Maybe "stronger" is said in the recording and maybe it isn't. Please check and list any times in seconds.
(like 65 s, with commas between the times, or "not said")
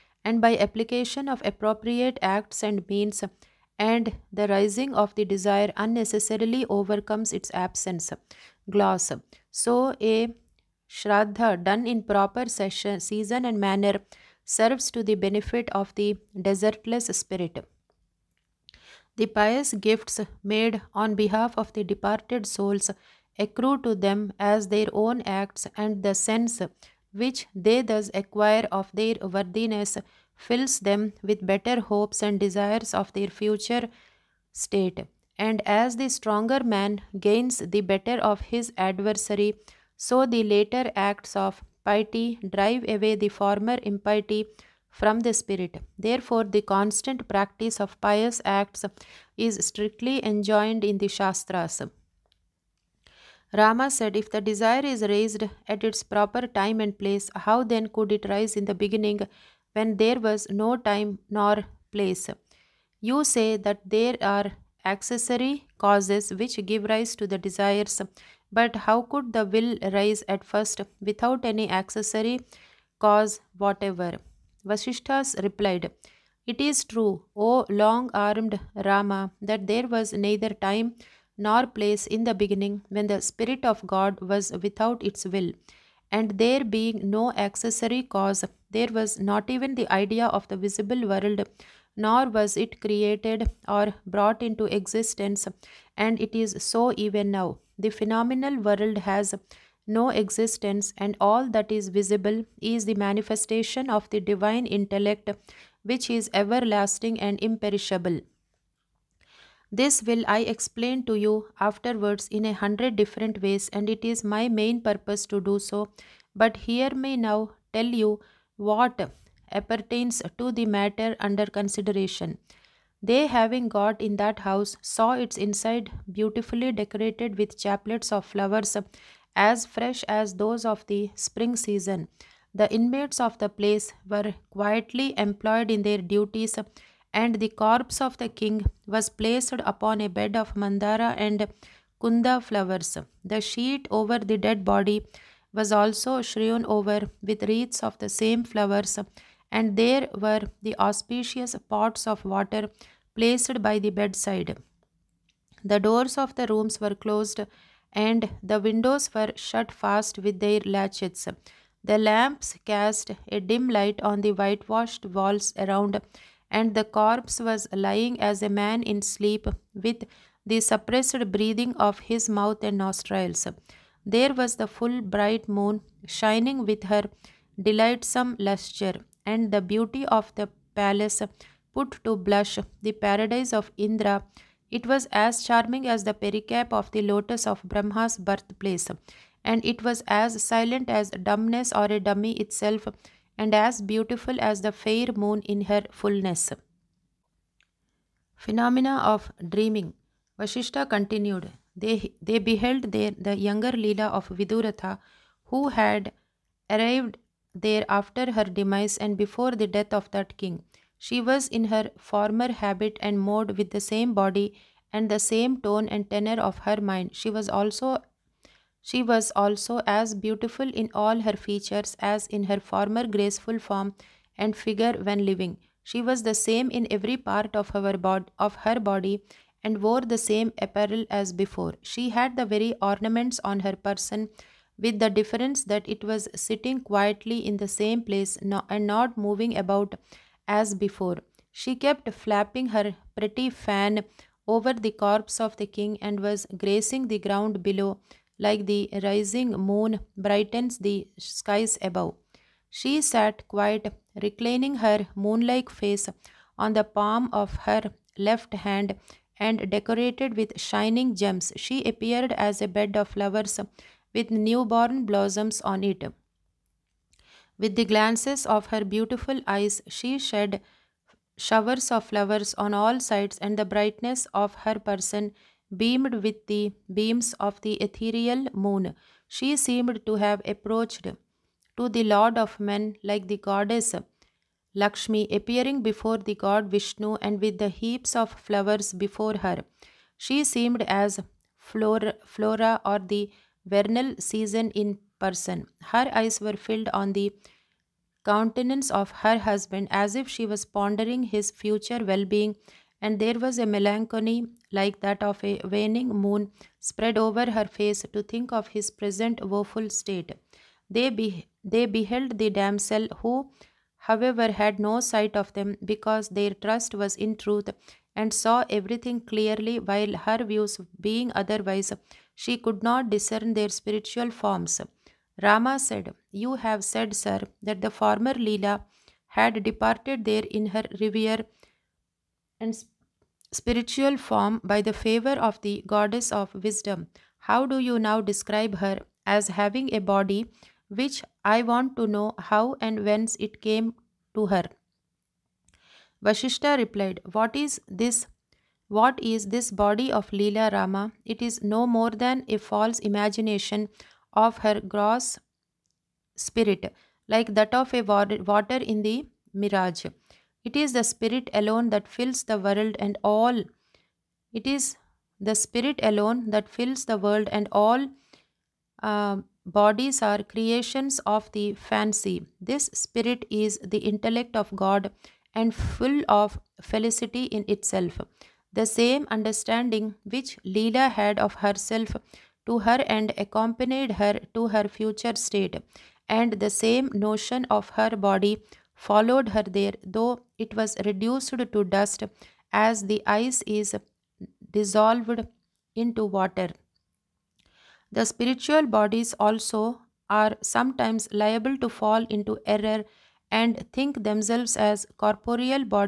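36 s.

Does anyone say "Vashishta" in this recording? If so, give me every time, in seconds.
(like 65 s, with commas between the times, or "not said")
200 s, 346 s.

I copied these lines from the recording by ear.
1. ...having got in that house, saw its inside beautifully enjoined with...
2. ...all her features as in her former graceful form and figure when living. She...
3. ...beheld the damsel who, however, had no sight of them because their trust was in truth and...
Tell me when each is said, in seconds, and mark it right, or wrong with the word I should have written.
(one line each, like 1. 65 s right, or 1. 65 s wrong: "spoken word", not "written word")
1. 123 s wrong: "decorated", not "enjoined"
2. 220 s right
3. 311 s right.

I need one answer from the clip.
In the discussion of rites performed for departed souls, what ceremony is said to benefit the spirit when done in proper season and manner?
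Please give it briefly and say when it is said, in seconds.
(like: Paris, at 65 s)
shraddha, at 10 s.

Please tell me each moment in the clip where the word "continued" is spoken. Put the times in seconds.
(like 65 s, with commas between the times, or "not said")
200 s.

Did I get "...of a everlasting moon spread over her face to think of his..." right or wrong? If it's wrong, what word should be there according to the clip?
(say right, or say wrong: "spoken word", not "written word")
wrong: "waning", not "everlasting".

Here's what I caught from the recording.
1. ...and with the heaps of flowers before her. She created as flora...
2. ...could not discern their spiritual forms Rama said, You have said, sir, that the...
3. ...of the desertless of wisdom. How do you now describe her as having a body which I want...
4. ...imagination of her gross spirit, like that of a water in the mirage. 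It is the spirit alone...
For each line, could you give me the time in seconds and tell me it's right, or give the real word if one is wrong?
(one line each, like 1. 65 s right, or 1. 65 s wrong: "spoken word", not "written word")
1. 287 s wrong: "seemed", not "created"
2. 322 s right
3. 335 s wrong: "goddess", not "desertless"
4. 352 s right.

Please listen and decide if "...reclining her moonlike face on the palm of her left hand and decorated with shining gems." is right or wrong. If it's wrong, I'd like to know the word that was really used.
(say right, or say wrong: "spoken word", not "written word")
right.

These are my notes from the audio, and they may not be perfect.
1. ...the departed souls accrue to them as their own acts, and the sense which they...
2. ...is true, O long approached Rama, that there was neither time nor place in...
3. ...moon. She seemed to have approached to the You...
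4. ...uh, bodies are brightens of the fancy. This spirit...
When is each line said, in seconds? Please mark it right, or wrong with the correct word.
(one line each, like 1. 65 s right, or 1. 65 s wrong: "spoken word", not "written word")
1. 21 s right
2. 76 s wrong: "armed", not "approached"
3. 278 s wrong: "Lord", not "You"
4. 369 s wrong: "creations", not "brightens".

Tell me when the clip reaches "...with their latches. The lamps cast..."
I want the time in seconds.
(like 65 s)
160 s.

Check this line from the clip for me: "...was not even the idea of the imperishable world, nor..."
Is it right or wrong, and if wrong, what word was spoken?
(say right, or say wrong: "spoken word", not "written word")
wrong: "visible", not "imperishable".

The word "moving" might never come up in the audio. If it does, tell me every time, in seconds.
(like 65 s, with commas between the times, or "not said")
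239 s.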